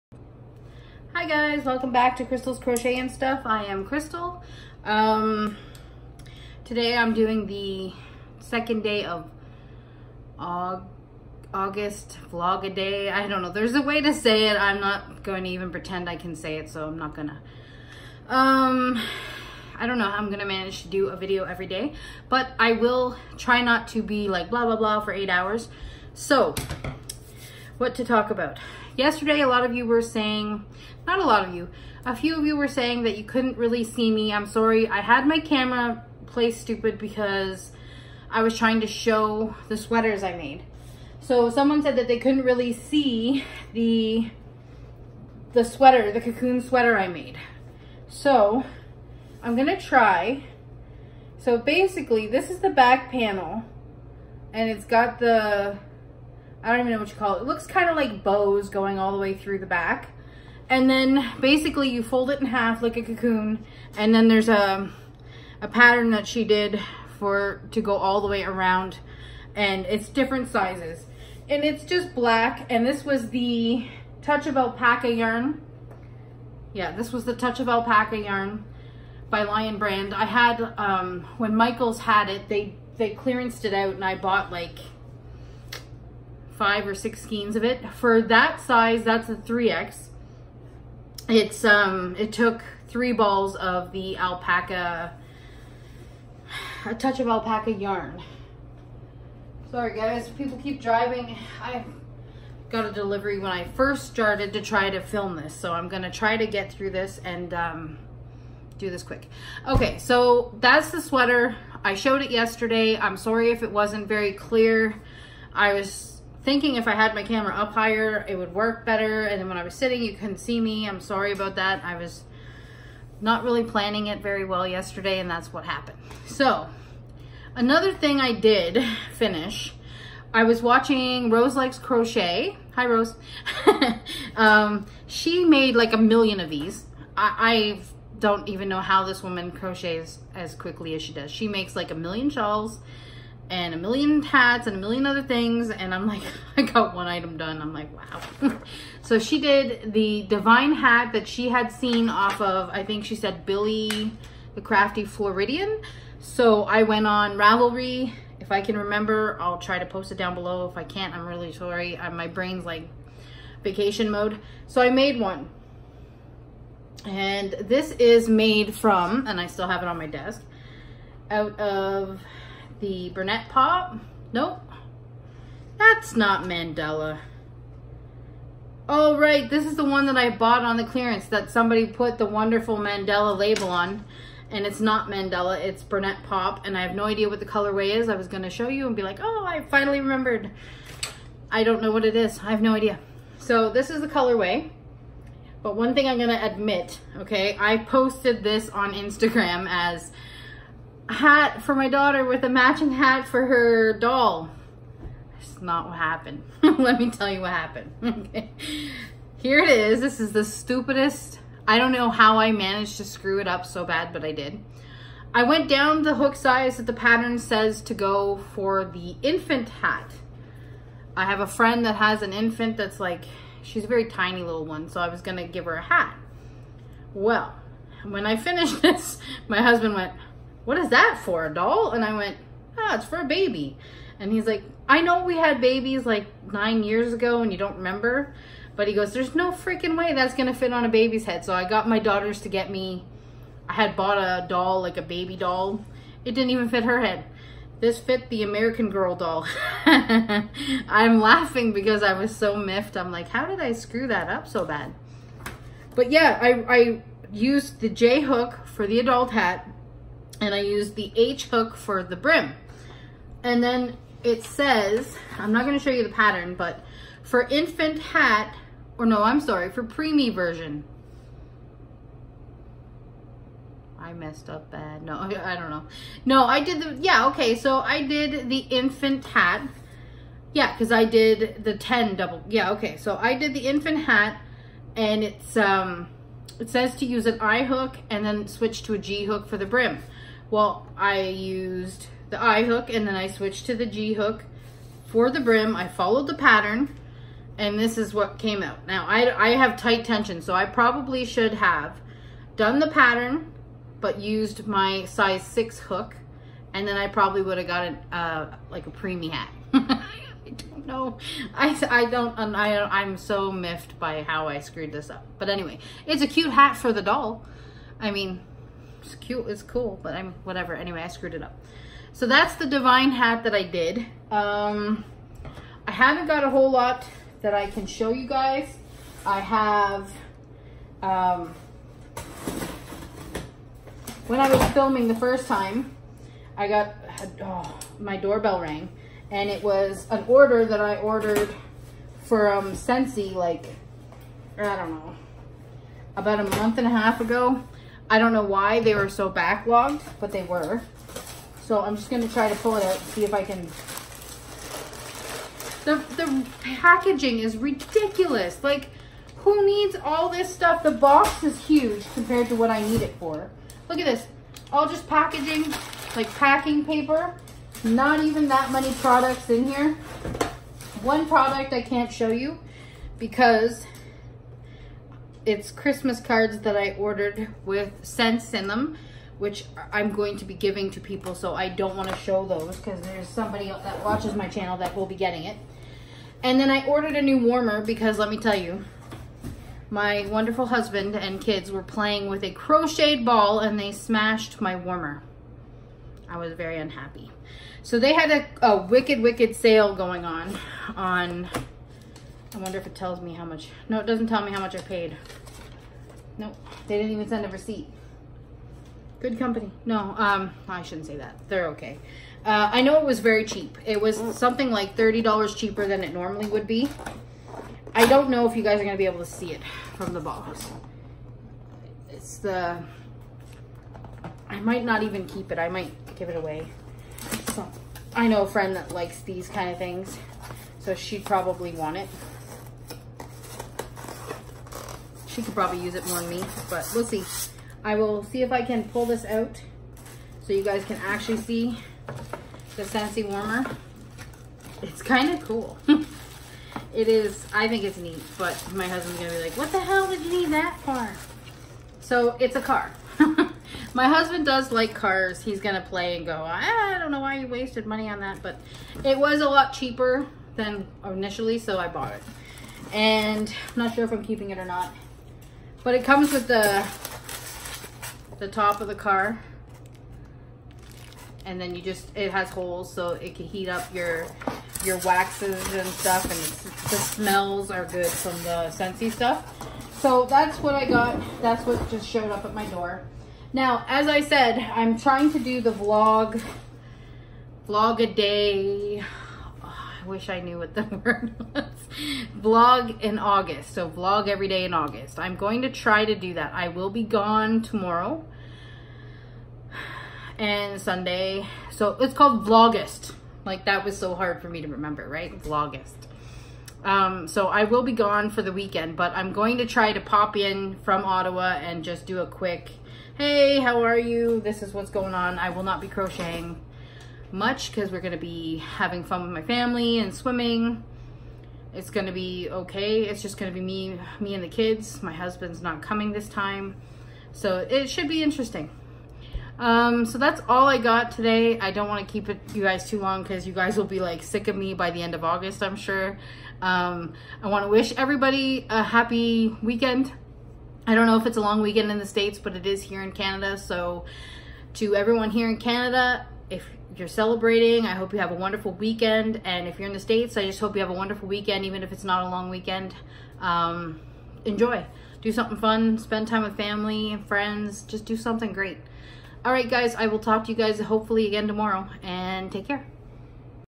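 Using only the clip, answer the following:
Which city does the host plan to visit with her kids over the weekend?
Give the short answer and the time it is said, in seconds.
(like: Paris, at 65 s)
Ottawa, at 511 s.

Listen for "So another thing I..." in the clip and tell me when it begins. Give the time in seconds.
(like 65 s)
126 s.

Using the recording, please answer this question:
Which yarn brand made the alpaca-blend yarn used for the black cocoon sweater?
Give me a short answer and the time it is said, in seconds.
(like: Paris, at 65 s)
Lion Brand, at 79 s.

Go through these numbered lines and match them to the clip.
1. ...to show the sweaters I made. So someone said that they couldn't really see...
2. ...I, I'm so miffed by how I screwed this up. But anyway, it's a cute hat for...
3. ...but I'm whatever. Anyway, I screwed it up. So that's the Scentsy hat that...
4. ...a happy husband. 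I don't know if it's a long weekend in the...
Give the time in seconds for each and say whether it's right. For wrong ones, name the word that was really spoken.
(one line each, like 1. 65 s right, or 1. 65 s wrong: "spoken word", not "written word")
1. 38 s right
2. 312 s right
3. 320 s wrong: "Divine", not "Scentsy"
4. 538 s wrong: "weekend", not "husband".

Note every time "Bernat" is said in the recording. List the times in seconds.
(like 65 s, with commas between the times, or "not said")
173 s, 185 s.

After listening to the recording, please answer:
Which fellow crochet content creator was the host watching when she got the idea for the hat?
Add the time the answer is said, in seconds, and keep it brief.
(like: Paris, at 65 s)
Rose Likes Crochet, at 131 s.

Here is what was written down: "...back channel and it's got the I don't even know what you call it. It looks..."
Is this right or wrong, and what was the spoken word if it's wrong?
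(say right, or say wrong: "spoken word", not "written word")
wrong: "panel", not "channel".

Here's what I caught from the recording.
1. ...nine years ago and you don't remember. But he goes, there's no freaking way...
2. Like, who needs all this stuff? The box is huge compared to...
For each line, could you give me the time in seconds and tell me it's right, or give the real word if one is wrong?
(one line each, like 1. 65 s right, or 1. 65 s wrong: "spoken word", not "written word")
1. 236 s right
2. 358 s right.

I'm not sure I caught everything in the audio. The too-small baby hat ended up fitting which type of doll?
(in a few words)
American Girl doll.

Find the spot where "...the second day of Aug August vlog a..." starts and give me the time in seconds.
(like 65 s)
7 s.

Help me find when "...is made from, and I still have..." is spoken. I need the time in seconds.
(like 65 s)
167 s.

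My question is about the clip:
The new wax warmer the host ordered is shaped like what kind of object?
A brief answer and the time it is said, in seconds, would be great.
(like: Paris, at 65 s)
A car, at 452 s.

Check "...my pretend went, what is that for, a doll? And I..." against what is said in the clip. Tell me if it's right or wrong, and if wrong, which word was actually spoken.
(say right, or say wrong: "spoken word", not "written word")
wrong: "husband", not "pretend".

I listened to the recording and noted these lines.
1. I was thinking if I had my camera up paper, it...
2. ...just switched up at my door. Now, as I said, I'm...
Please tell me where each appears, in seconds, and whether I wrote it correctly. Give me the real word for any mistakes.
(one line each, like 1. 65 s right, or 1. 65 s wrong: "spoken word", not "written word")
1. 115 s wrong: "higher", not "paper"
2. 481 s wrong: "showed", not "switched".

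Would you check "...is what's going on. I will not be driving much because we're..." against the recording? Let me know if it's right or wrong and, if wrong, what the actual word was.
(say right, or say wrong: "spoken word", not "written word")
wrong: "crocheting", not "driving".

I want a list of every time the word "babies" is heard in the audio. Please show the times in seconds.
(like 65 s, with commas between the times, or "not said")
235 s.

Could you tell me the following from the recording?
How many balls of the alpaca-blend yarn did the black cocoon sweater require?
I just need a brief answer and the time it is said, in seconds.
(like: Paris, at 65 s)
3, at 92 s.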